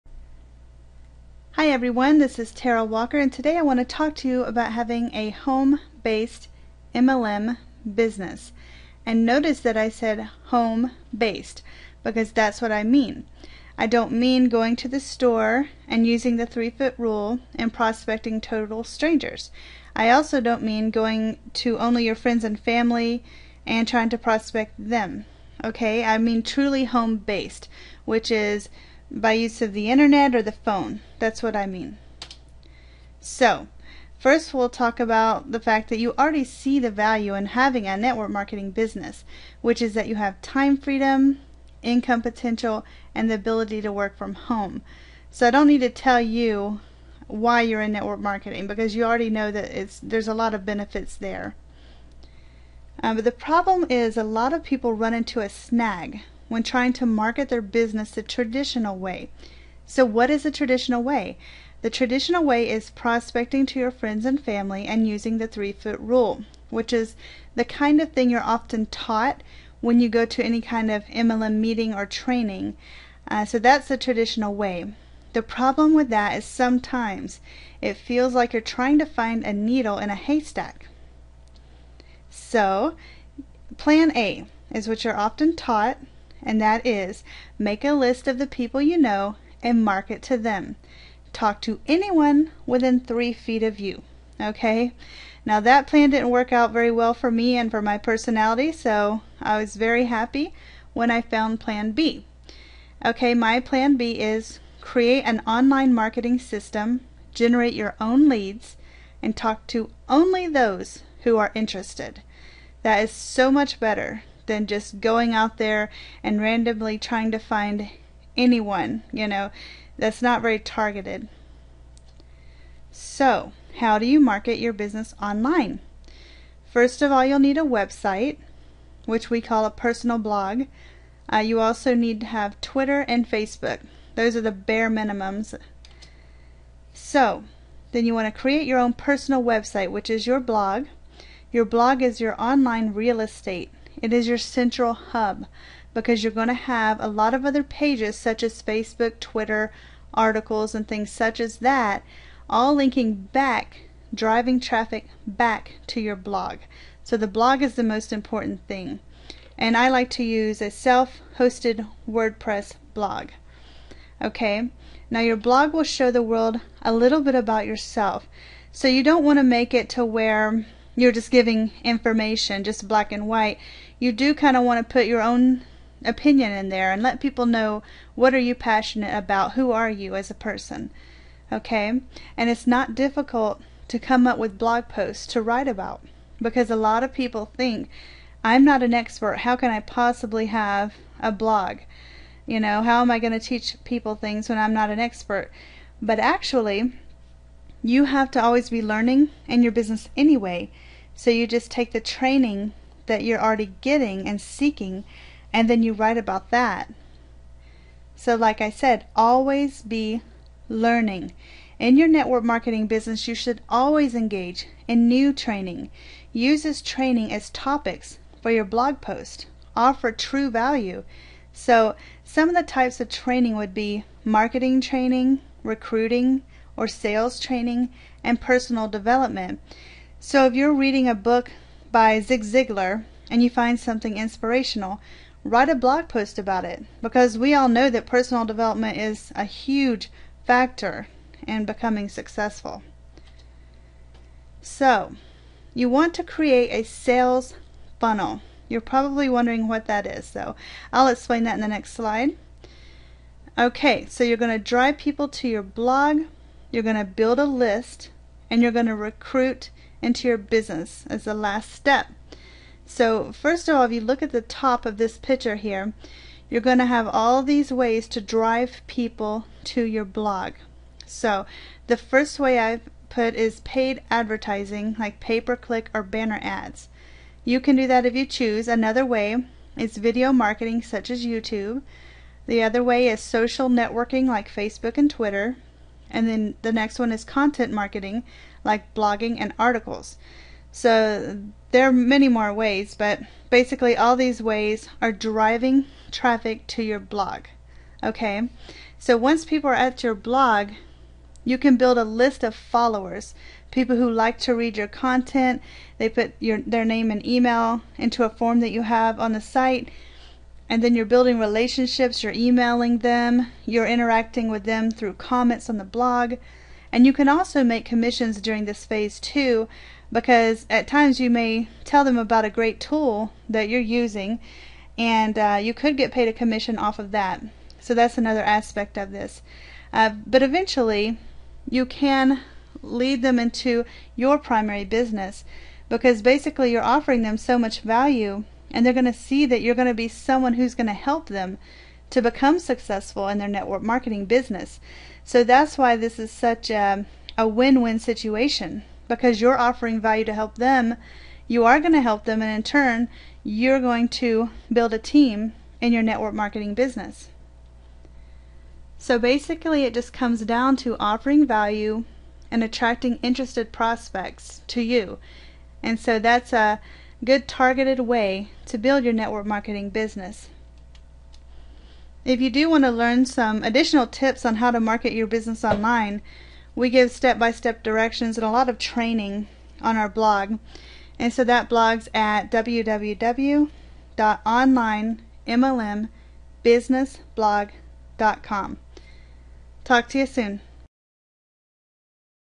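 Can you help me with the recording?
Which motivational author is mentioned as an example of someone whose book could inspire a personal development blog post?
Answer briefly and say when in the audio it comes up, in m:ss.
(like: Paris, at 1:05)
Zig Ziglar, at 3:52.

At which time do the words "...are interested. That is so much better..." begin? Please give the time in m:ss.
1:51.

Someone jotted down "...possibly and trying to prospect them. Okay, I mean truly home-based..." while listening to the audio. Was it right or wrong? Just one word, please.
wrong.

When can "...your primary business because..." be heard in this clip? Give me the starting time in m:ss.
5:34.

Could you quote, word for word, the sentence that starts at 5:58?
So basically, it just comes down to offering value and attracting interested prospects to you.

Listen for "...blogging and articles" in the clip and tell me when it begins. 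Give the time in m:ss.
4:48.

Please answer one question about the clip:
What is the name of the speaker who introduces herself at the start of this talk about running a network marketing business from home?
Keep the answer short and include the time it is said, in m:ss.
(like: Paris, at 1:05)
Tara Walker, at 0:02.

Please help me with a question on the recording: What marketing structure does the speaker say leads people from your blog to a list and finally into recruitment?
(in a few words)
sales funnel.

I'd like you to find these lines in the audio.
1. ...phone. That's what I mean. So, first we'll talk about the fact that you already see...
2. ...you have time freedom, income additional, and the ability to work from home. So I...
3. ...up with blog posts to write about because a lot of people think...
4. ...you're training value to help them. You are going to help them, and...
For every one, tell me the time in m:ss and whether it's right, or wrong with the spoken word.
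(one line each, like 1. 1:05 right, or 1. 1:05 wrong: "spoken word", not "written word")
1. 0:30 right
2. 0:40 wrong: "potential", not "additional"
3. 3:04 right
4. 5:49 wrong: "offering", not "training".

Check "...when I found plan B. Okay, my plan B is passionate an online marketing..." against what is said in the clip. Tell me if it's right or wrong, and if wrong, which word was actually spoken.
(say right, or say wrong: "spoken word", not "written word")
wrong: "create", not "passionate".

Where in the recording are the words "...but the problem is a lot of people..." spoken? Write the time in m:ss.
0:53.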